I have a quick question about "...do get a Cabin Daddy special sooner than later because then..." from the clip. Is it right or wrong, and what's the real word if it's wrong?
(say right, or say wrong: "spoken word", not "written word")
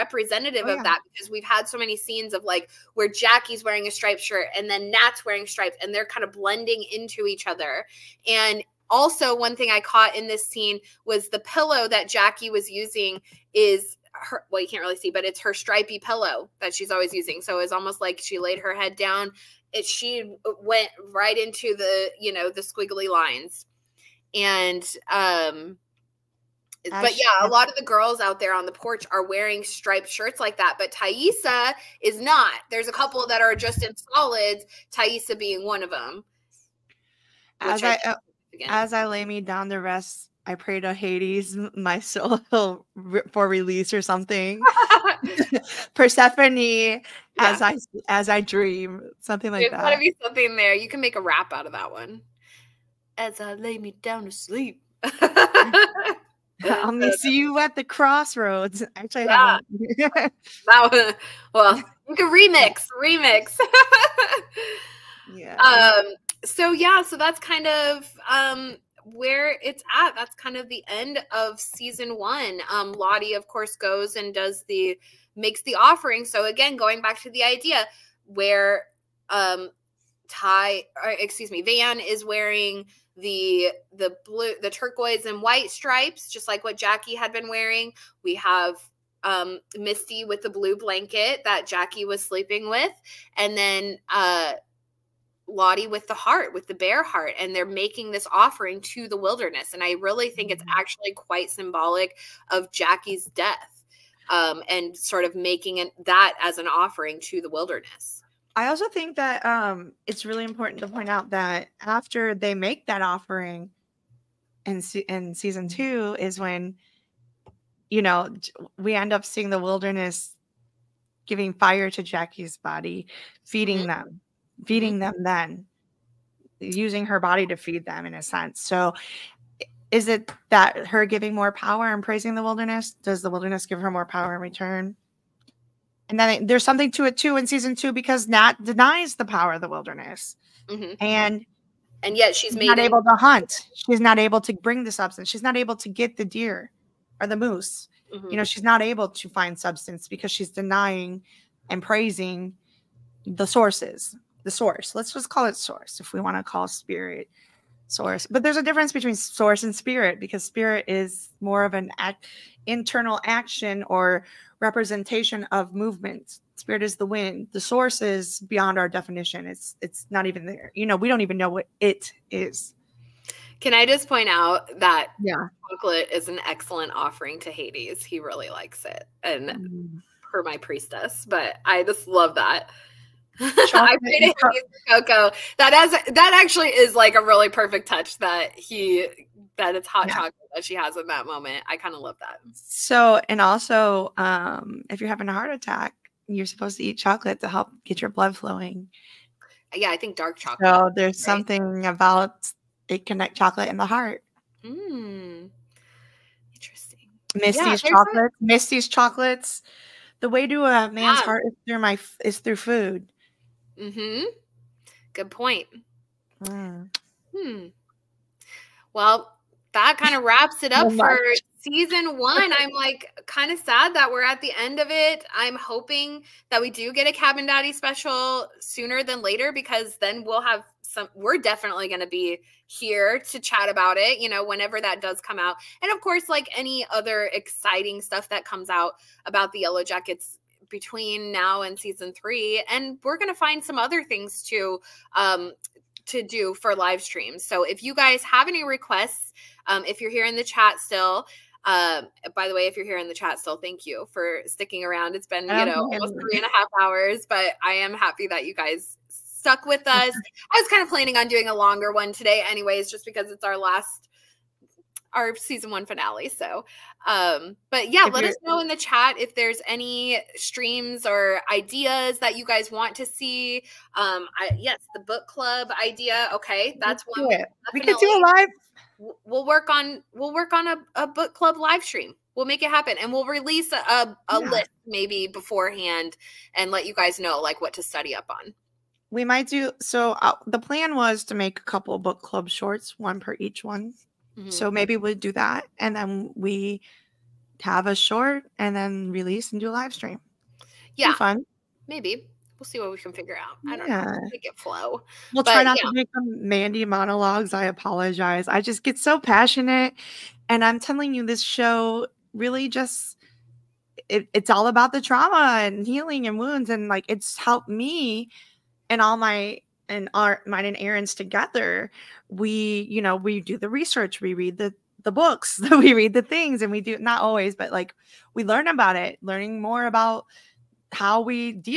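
right.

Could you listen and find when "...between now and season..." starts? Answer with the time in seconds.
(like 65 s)
240 s.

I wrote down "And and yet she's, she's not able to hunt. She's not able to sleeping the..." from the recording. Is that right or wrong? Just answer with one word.
wrong.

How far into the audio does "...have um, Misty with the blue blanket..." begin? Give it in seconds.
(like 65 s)
88 s.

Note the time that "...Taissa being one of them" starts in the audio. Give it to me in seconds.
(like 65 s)
34 s.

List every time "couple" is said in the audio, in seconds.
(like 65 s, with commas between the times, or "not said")
32 s, 291 s.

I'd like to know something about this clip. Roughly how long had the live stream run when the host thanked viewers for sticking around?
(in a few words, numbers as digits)
Three and a half hours.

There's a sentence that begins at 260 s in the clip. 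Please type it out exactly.
I was kind of planning on doing a longer one today, anyways, just because it's our last our season one finale.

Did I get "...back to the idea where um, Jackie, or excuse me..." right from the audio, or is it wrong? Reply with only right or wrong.
wrong.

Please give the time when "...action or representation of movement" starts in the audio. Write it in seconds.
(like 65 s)
163 s.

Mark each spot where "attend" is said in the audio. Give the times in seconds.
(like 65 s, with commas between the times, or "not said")
not said.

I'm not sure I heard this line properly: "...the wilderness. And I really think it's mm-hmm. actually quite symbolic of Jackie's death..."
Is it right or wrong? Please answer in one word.
right.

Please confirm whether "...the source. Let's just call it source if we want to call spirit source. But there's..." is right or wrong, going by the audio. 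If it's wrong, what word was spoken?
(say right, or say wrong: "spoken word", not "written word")
right.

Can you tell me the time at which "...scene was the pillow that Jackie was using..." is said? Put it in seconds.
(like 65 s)
10 s.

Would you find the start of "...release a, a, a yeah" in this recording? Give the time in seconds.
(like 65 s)
283 s.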